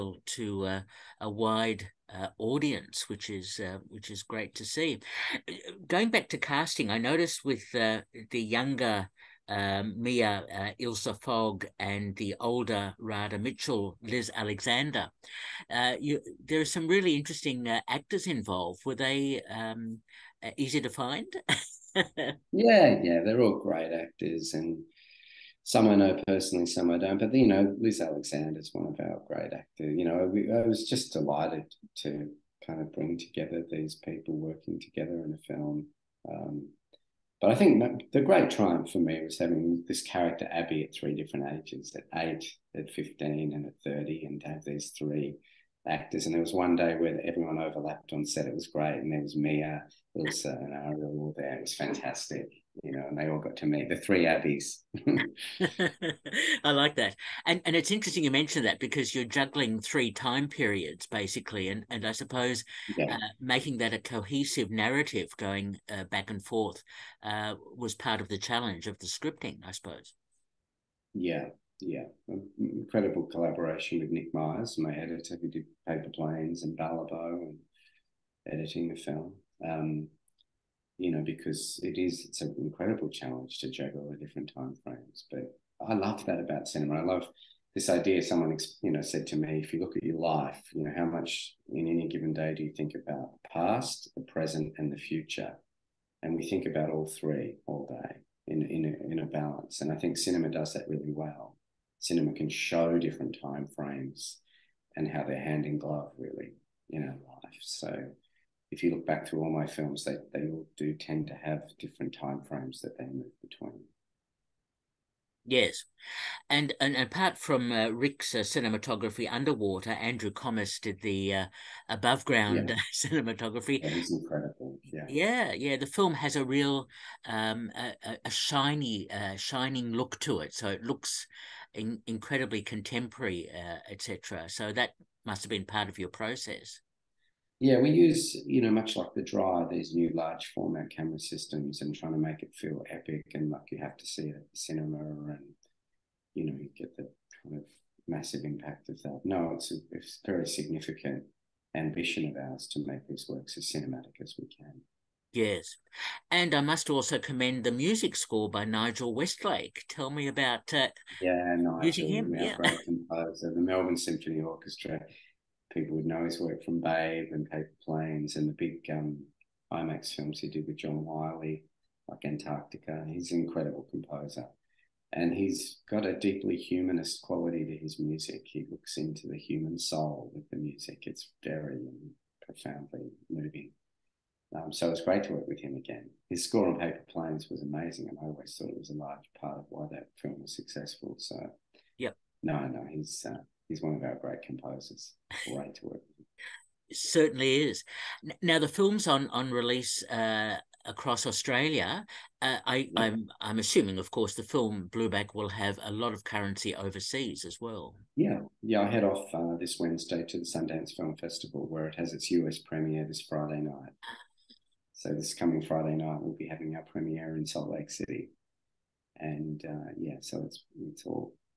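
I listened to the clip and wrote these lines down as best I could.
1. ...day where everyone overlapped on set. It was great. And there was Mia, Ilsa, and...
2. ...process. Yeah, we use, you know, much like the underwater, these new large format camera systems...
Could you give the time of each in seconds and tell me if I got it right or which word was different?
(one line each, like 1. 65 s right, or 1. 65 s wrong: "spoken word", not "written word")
1. 46 s right
2. 136 s wrong: "dryer", not "underwater".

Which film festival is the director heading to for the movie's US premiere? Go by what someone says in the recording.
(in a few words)
Sundance Film Festival.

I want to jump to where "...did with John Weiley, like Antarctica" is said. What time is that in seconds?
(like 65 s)
170 s.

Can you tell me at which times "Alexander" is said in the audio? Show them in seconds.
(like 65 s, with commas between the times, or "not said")
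14 s, 28 s.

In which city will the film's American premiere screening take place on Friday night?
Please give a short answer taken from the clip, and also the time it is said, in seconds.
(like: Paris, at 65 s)
Salt Lake City, at 217 s.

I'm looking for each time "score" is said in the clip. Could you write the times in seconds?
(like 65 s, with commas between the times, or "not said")
158 s, 186 s.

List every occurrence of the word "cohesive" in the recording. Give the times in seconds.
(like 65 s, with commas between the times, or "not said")
63 s.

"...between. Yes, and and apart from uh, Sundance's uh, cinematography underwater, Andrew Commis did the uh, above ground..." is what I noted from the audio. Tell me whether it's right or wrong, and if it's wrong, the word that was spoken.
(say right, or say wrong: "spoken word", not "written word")
wrong: "Rick", not "Sundance".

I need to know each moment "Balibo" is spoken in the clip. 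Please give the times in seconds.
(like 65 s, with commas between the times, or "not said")
76 s.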